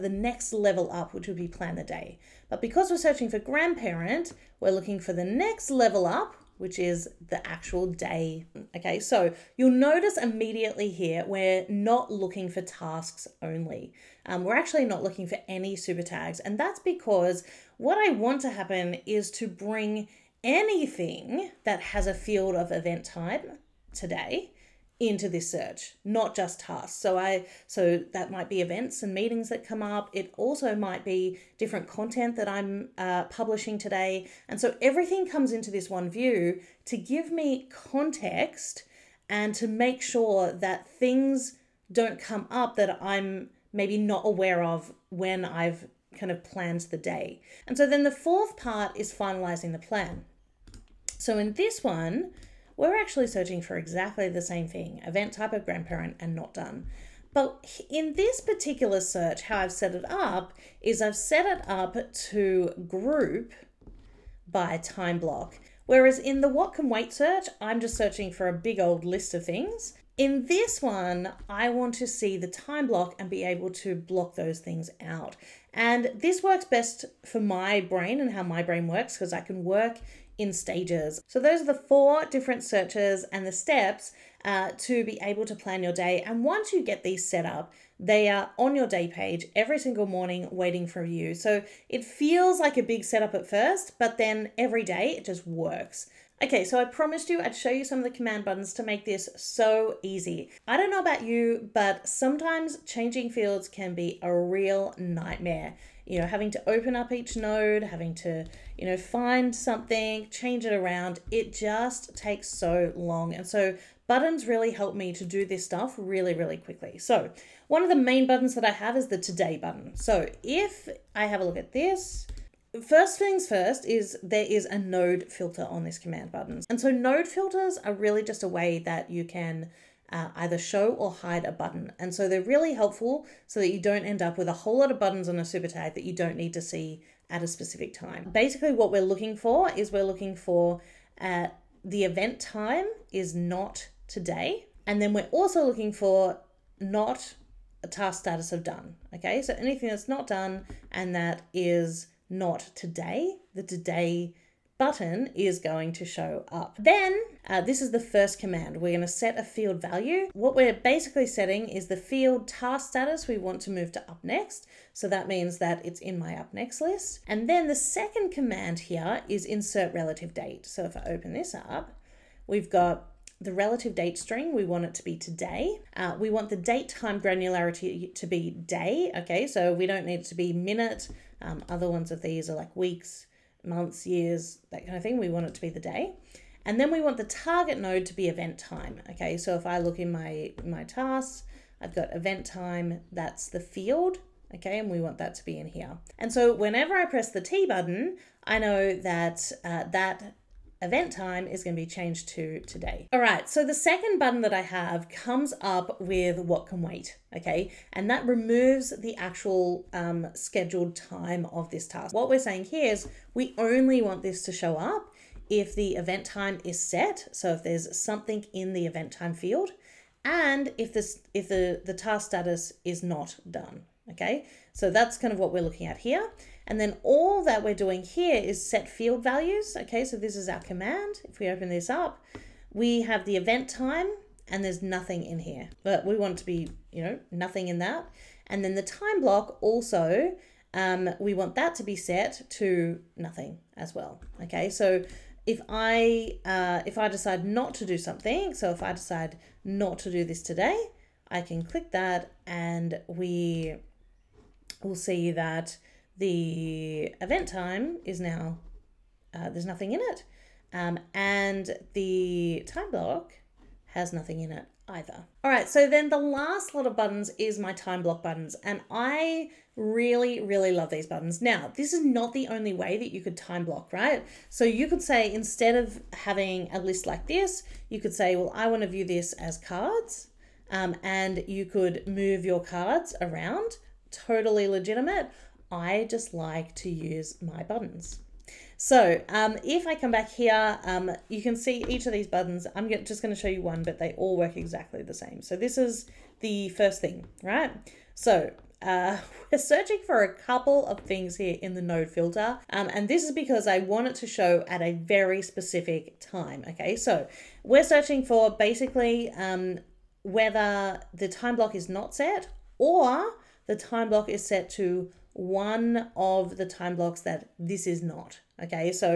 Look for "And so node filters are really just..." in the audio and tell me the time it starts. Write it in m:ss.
2:06.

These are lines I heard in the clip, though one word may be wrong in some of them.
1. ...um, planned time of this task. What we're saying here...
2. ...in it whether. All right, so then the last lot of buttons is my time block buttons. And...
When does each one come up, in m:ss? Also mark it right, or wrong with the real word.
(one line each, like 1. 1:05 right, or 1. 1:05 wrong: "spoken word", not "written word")
1. 3:29 wrong: "scheduled", not "planned"
2. 4:24 wrong: "either", not "whether".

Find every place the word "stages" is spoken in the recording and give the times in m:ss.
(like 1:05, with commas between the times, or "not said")
1:20.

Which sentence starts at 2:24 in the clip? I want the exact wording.
And then we're also looking for not a task status of done.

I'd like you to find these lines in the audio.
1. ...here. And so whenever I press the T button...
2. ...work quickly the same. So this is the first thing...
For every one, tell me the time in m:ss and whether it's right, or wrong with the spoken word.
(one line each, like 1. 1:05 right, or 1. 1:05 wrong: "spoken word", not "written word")
1. 3:15 right
2. 4:54 wrong: "exactly", not "quickly".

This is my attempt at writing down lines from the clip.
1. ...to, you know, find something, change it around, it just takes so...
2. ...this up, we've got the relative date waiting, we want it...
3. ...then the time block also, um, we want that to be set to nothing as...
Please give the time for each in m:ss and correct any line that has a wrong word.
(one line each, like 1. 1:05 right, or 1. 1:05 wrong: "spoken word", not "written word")
1. 1:48 right
2. 2:51 wrong: "string", not "waiting"
3. 3:58 right.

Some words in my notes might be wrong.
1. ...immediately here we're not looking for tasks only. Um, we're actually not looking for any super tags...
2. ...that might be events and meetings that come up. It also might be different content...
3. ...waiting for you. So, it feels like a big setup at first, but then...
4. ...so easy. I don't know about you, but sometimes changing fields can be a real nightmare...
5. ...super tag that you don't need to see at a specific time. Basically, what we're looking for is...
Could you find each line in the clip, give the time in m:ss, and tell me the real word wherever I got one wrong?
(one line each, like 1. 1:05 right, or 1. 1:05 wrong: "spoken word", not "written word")
1. 0:10 right
2. 0:28 right
3. 1:30 right
4. 1:39 right
5. 2:15 right.